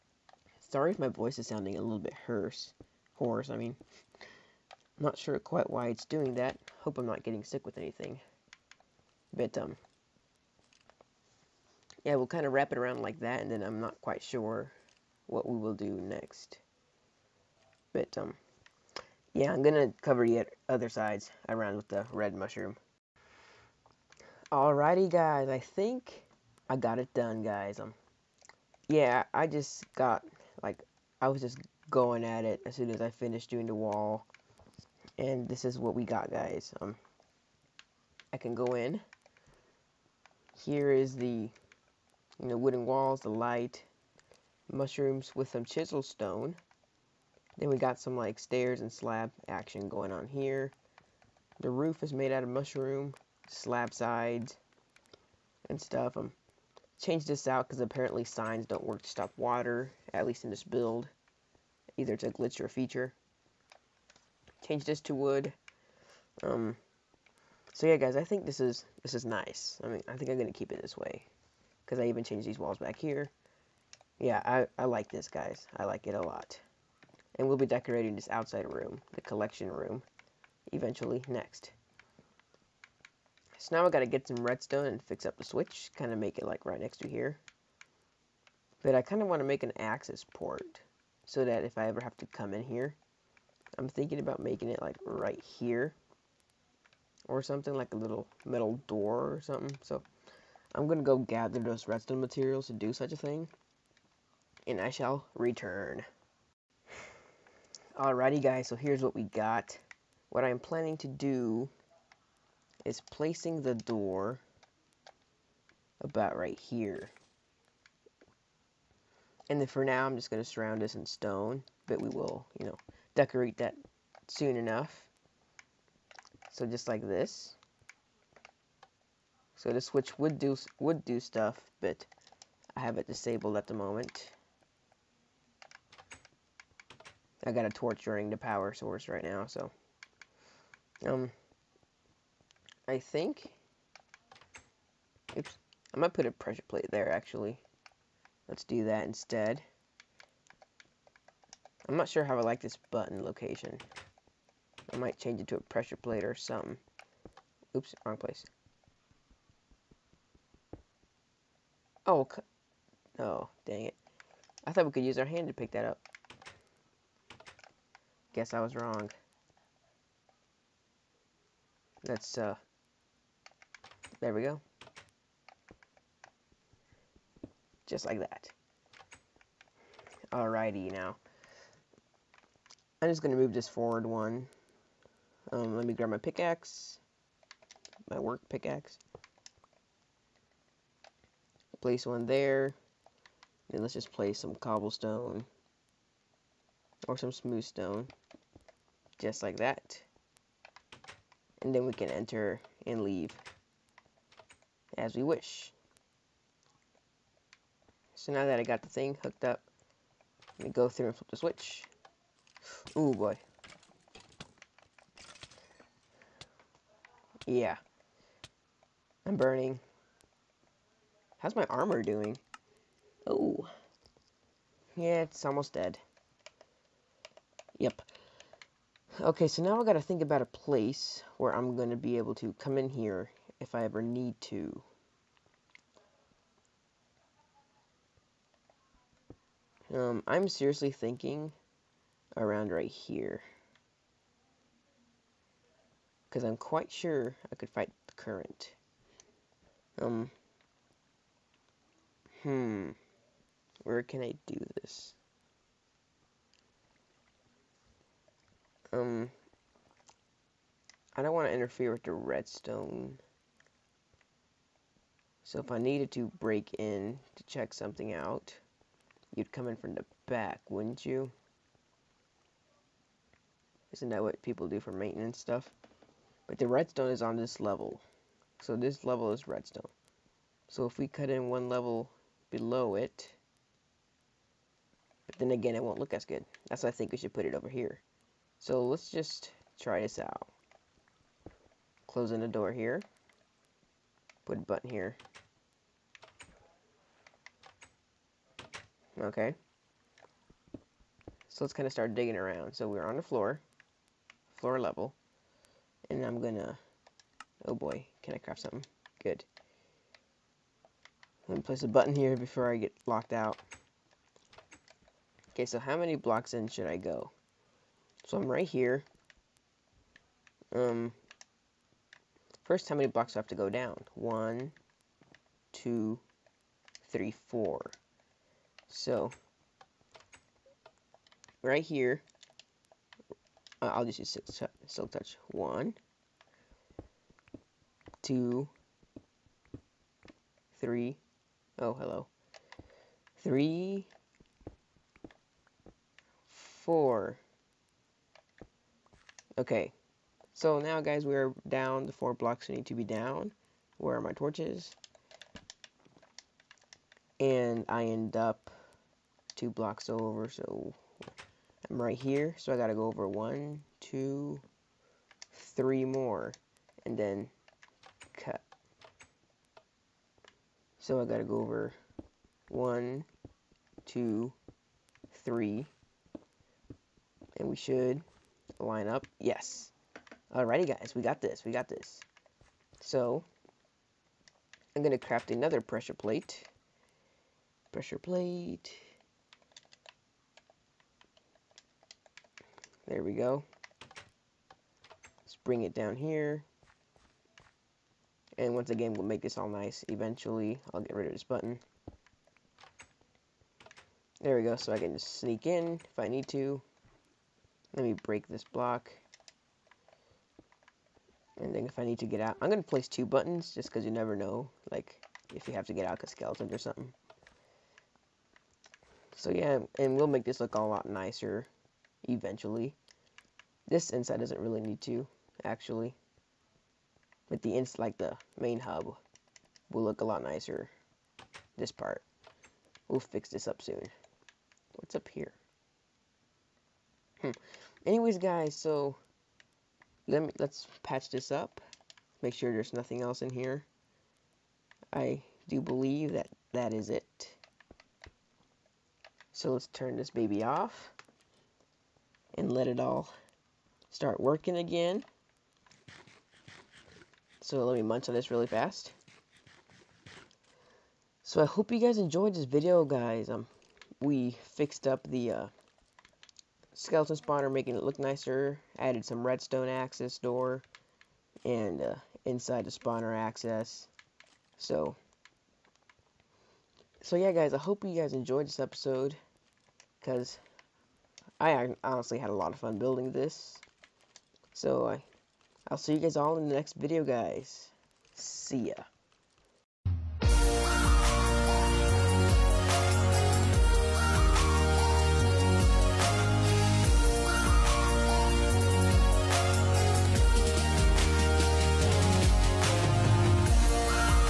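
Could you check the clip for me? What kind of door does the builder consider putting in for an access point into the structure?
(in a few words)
Metal door.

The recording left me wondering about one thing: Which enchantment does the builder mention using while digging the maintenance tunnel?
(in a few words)
Silk touch.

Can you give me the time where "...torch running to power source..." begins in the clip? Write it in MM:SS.
02:17.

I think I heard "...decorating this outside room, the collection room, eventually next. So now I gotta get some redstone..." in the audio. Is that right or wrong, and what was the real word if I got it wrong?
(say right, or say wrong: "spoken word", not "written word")
right.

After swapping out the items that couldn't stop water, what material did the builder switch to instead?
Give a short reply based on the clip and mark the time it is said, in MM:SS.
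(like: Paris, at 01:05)
Wood, at 01:05.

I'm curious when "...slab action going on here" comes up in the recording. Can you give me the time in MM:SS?
00:48.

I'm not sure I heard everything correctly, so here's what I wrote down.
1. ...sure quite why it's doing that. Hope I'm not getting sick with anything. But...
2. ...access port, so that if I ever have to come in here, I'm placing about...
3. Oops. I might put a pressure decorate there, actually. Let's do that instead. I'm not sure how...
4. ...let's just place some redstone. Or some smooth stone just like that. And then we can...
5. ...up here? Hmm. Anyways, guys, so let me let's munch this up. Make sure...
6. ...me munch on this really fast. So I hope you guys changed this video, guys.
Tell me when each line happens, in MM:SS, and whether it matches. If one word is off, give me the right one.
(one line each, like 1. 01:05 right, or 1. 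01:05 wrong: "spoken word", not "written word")
1. 00:05 right
2. 01:29 wrong: "thinking", not "placing"
3. 02:25 wrong: "plate", not "decorate"
4. 03:13 wrong: "cobblestone", not "redstone"
5. 07:15 wrong: "patch", not "munch"
6. 07:37 wrong: "enjoyed", not "changed".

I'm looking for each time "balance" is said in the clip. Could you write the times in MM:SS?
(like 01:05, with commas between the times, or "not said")
not said.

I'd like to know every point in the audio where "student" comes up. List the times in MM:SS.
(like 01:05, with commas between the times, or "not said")
not said.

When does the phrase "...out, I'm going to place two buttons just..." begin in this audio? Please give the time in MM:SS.
06:52.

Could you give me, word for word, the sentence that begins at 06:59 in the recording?
So yeah, and we'll make this look a lot nicer eventually.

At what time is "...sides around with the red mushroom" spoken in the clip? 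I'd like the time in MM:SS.
00:20.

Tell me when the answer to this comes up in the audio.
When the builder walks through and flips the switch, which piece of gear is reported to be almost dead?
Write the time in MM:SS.
03:41.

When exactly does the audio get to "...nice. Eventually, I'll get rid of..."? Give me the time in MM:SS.
06:39.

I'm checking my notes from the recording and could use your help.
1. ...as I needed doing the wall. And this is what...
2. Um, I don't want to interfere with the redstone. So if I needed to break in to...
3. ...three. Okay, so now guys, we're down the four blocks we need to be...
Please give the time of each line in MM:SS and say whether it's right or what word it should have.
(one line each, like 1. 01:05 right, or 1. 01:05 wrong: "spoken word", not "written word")
1. 00:32 wrong: "finished", not "needed"
2. 04:18 right
3. 05:46 wrong: "four", not "three".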